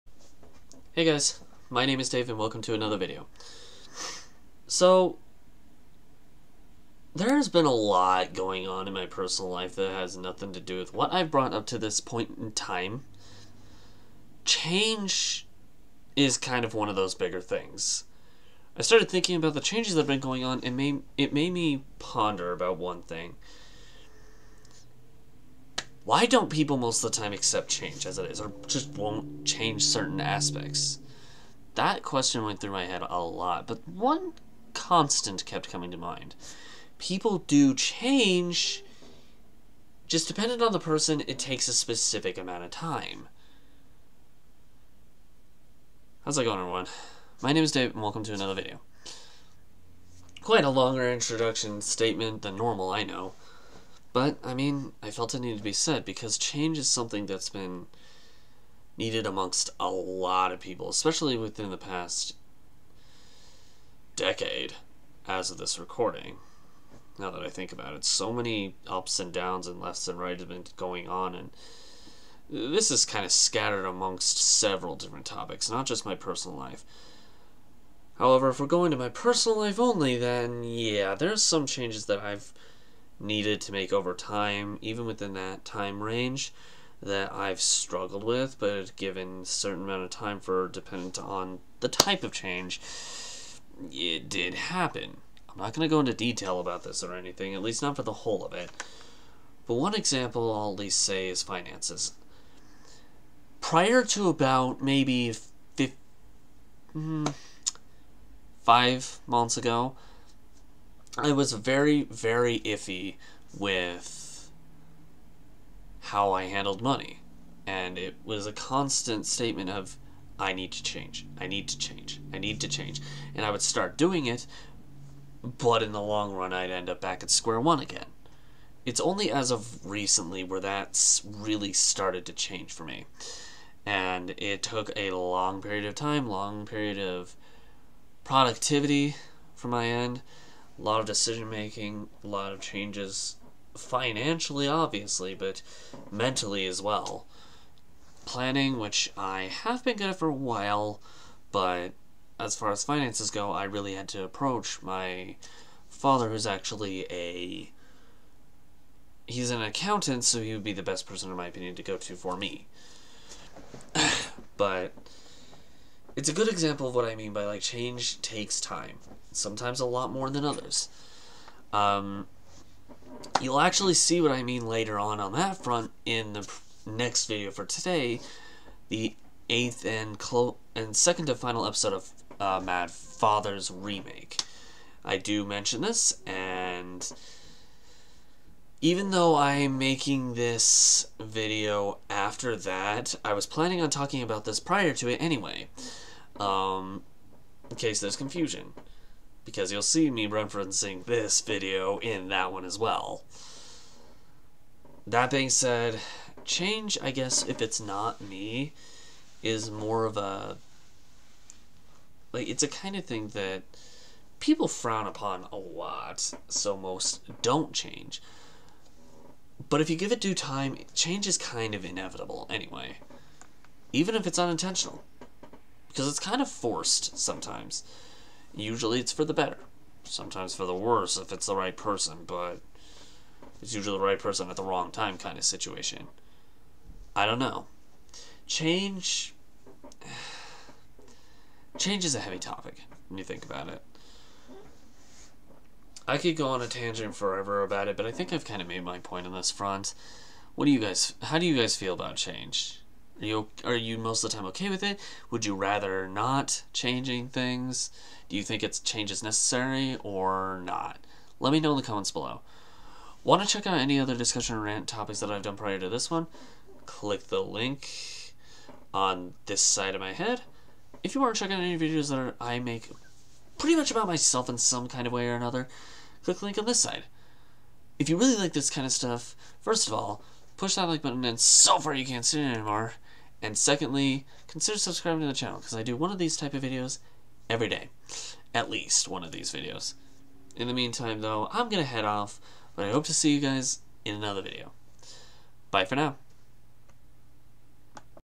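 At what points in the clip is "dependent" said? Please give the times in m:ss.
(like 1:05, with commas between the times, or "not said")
0:40, 1:30.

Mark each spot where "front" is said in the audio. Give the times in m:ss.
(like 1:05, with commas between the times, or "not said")
2:55, 4:09.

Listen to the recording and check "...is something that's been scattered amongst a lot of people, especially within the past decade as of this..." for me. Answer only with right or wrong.
wrong.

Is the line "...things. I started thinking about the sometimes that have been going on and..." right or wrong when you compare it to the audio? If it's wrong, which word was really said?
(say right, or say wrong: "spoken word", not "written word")
wrong: "changes", not "sometimes".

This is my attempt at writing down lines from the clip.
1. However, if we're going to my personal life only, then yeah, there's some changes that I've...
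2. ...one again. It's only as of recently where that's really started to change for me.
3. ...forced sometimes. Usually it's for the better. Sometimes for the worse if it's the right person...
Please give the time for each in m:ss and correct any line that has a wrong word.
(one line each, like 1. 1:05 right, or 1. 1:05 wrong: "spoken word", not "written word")
1. 1:18 right
2. 2:07 right
3. 3:46 right.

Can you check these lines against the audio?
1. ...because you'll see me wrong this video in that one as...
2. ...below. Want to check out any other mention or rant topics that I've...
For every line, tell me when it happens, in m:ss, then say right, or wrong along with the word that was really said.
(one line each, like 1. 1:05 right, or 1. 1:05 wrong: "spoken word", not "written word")
1. 3:19 wrong: "referencing", not "wrong"
2. 4:22 wrong: "discussion", not "mention".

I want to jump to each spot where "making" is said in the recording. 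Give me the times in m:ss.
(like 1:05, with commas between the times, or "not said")
2:21, 3:09.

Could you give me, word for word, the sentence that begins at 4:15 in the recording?
Would you rather not changing things?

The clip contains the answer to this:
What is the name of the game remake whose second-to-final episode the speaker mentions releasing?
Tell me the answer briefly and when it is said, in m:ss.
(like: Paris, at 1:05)
Mad Father, at 3:02.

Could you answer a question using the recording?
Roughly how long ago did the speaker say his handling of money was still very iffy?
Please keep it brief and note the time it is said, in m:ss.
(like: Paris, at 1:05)
5 months, at 1:48.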